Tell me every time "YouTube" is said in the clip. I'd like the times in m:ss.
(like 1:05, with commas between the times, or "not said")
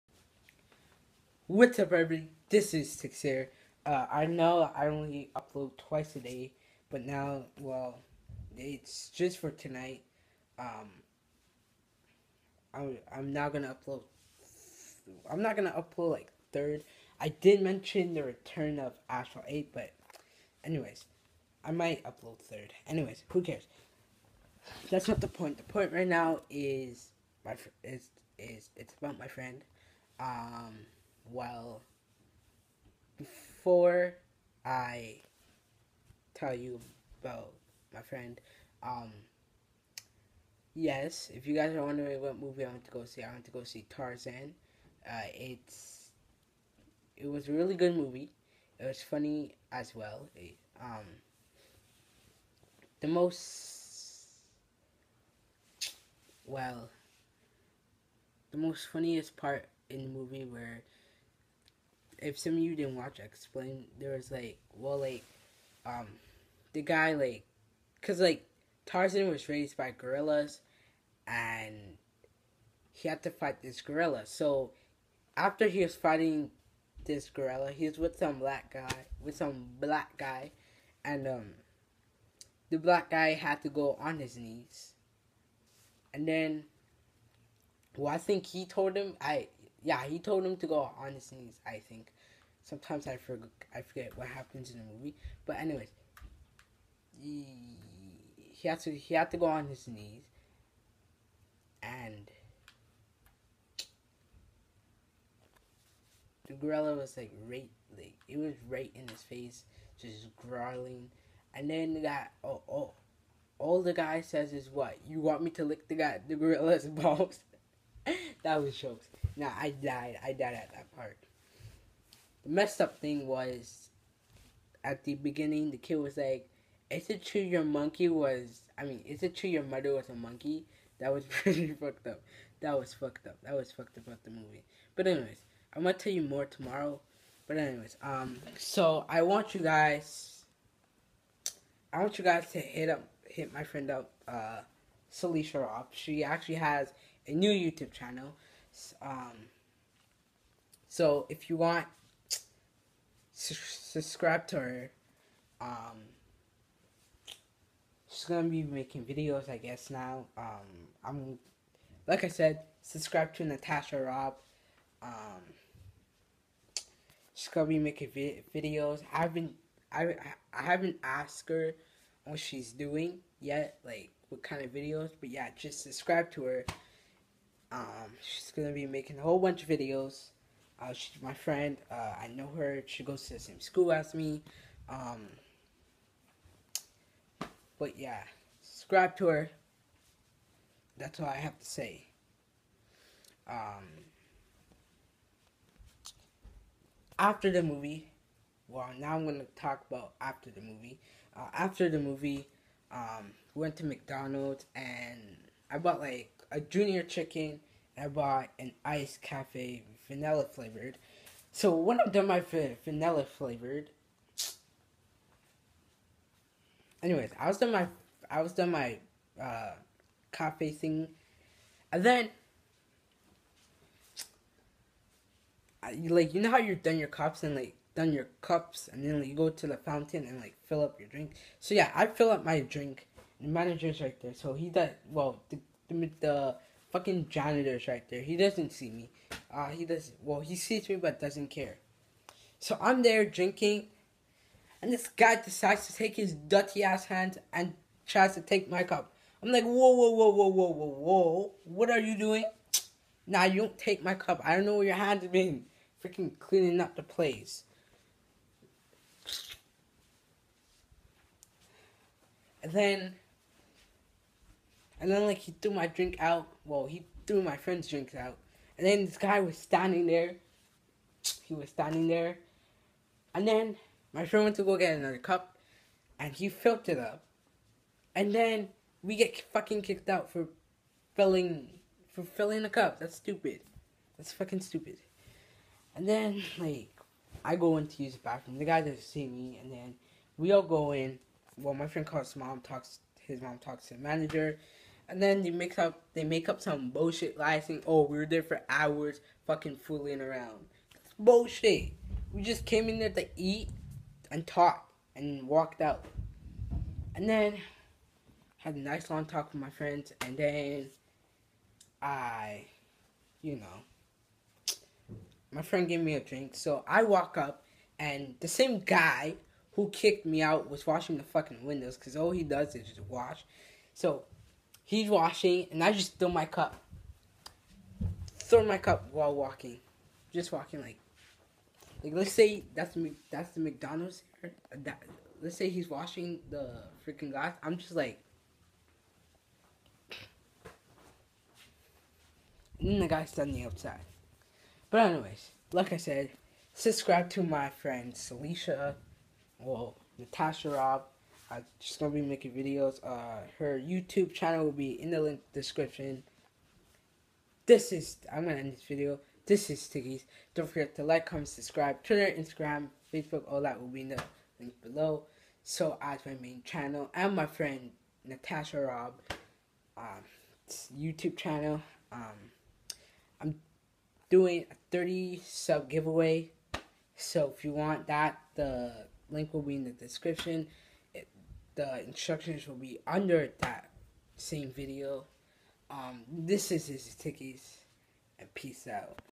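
2:27, 5:53, 6:10.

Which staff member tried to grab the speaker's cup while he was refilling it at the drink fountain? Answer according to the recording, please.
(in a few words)
janitor.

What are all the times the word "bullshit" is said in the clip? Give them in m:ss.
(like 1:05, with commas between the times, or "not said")
4:56, 5:01.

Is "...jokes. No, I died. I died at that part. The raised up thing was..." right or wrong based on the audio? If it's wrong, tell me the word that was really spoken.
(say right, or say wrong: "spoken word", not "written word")
wrong: "messed", not "raised".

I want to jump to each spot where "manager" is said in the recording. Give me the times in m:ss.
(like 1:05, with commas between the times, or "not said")
3:53, 4:53.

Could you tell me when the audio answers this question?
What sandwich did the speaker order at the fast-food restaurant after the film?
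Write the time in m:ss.
3:26.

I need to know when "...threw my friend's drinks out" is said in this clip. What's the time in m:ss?
4:27.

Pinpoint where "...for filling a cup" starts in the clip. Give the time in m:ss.
4:42.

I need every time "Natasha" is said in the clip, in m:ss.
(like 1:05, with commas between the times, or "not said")
2:43, 5:50, 6:08.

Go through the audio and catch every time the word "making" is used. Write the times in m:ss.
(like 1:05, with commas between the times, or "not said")
2:38, 2:47, 2:58, 5:52.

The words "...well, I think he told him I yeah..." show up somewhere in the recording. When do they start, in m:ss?
1:27.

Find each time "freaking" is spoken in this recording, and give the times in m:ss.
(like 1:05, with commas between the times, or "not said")
4:16, 5:37.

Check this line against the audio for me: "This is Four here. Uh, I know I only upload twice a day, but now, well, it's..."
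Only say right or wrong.
wrong.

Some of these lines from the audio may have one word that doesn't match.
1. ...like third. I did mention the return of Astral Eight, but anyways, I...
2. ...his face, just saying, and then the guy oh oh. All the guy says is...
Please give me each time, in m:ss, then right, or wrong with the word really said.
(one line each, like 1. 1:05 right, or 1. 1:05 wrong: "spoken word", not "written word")
1. 0:16 right
2. 1:49 wrong: "growling", not "saying".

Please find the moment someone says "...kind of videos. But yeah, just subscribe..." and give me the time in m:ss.
2:54.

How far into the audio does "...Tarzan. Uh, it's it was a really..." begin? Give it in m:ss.
0:43.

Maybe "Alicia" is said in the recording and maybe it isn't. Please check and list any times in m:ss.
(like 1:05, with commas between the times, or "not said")
5:48.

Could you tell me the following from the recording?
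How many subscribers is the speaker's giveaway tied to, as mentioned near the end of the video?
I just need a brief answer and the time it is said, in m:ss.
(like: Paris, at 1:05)
30, at 6:14.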